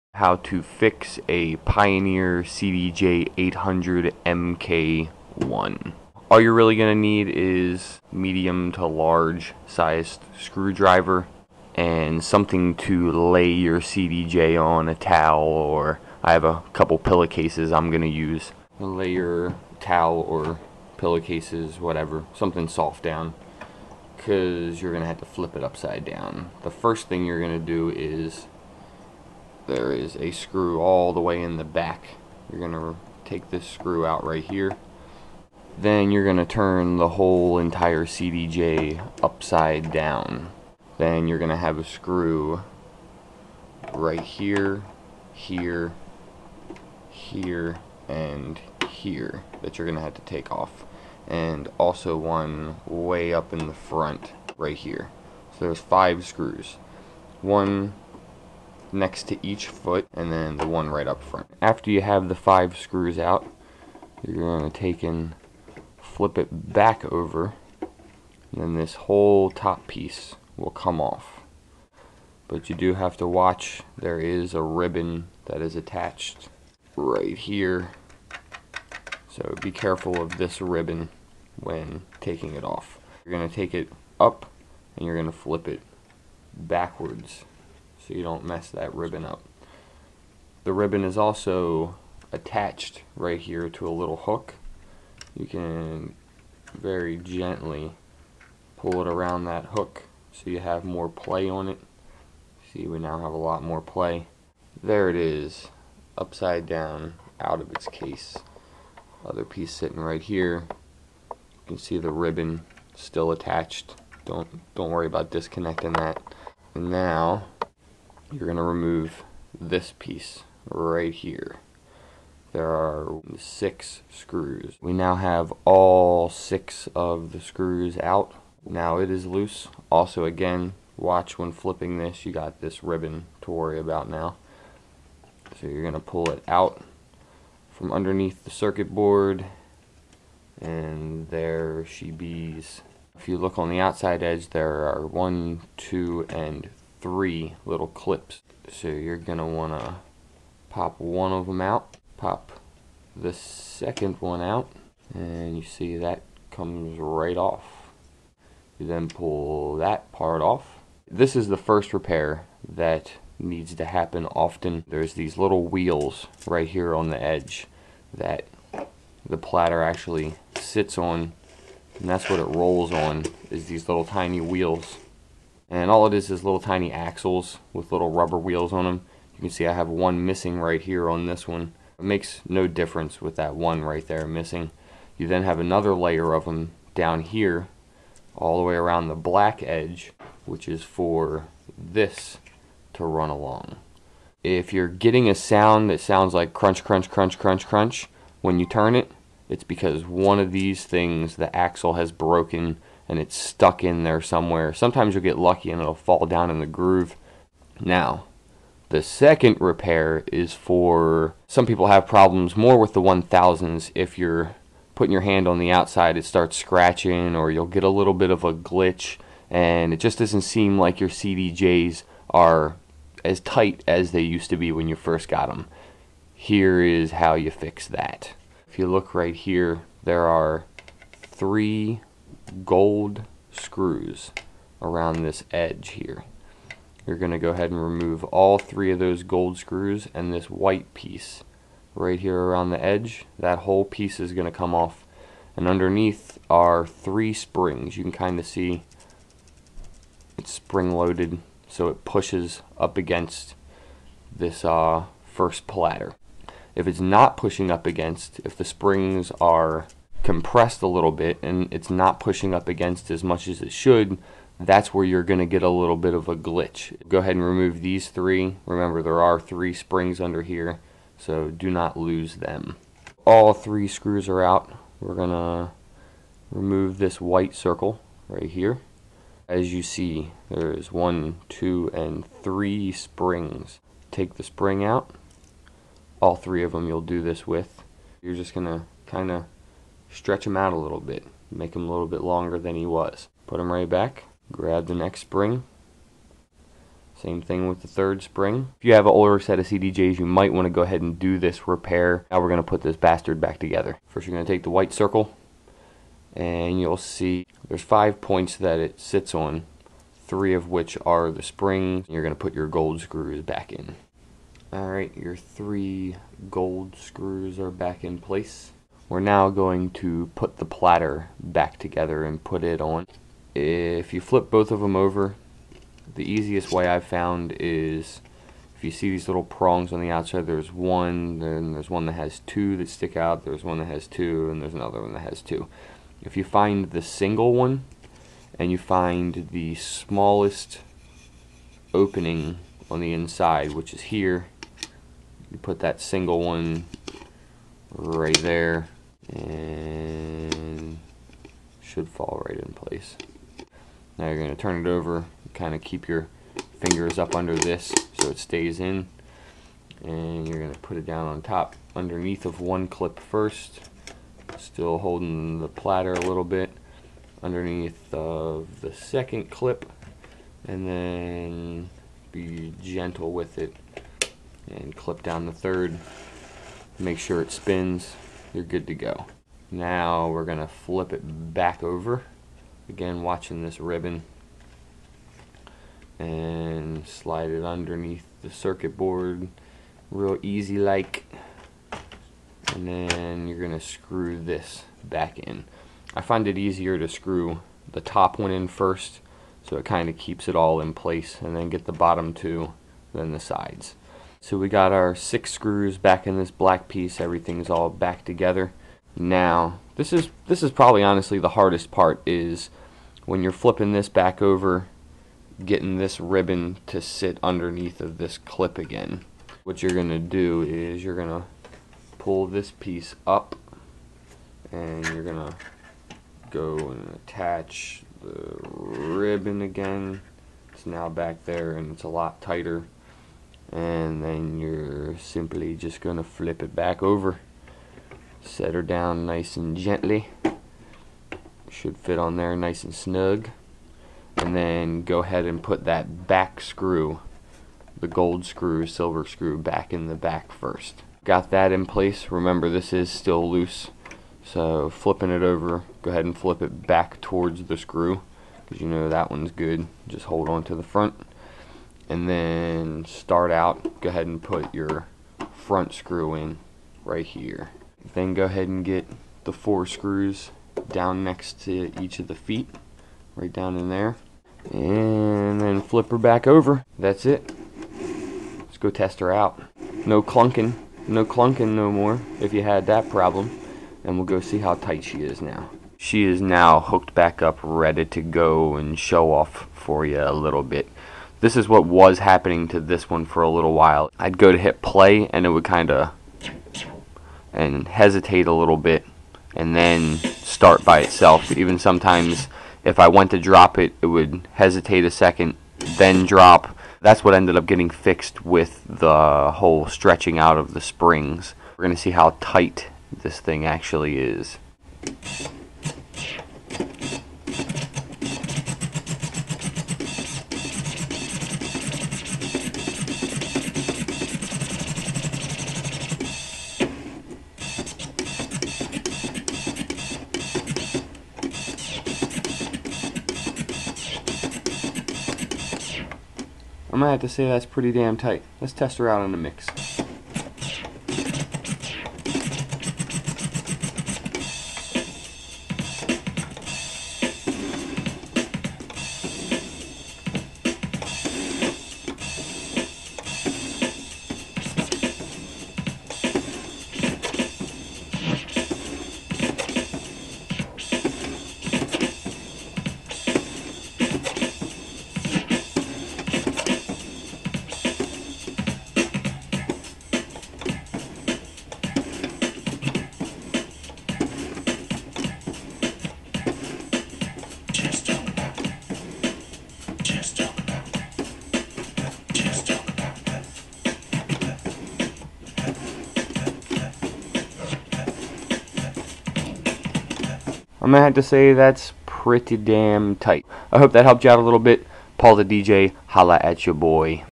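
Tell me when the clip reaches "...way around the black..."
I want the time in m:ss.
3:08.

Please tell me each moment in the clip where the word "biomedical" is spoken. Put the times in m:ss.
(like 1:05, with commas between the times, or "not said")
not said.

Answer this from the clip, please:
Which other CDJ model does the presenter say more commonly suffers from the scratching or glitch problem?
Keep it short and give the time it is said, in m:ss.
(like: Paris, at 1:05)
The 1000s, at 3:32.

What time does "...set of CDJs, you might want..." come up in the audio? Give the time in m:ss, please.
4:59.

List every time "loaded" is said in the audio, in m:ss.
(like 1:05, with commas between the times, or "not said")
4:10.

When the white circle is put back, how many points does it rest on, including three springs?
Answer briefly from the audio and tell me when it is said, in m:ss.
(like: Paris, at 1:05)
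5, at 5:07.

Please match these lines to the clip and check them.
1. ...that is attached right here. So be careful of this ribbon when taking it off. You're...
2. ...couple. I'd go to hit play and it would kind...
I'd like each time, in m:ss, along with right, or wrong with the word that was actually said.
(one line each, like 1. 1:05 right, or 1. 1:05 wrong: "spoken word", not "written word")
1. 1:15 right
2. 8:13 wrong: "while", not "couple".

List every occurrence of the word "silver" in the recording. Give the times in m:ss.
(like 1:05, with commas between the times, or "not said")
7:28.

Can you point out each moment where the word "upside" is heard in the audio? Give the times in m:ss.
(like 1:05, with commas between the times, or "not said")
0:25, 0:39, 1:46.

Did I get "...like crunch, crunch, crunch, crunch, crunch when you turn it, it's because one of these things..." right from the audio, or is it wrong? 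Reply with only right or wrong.
right.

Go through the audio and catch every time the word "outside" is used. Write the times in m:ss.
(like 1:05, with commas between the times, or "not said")
2:23, 3:35, 5:30.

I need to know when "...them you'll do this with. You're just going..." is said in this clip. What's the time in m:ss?
4:46.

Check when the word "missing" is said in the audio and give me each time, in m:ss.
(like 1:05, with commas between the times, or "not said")
3:00, 3:04.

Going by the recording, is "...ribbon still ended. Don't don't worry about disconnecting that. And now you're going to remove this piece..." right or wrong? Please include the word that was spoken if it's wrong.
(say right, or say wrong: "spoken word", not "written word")
wrong: "attached", not "ended".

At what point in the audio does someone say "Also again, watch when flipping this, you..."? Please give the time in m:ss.
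2:09.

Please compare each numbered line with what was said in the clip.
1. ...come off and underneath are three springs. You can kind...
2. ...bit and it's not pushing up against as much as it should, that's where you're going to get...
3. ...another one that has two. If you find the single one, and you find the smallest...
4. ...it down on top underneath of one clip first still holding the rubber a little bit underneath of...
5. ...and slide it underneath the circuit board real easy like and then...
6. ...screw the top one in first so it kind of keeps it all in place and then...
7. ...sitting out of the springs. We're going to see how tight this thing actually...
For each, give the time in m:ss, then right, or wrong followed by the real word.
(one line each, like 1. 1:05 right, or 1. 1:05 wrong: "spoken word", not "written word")
1. 4:04 right
2. 4:21 right
3. 5:34 right
4. 6:00 wrong: "platter", not "rubber"
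5. 6:26 right
6. 6:37 right
7. 8:29 wrong: "stretching", not "sitting".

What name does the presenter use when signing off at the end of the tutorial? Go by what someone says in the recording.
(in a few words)
Paul the DJ.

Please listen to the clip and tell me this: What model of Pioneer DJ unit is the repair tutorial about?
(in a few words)
CDJ 800 MK1.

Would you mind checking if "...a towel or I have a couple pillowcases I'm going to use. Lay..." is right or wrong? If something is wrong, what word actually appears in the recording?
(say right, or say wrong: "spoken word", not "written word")
right.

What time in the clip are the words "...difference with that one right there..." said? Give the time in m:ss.
3:02.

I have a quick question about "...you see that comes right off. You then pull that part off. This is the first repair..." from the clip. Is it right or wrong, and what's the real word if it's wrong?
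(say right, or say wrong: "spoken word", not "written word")
right.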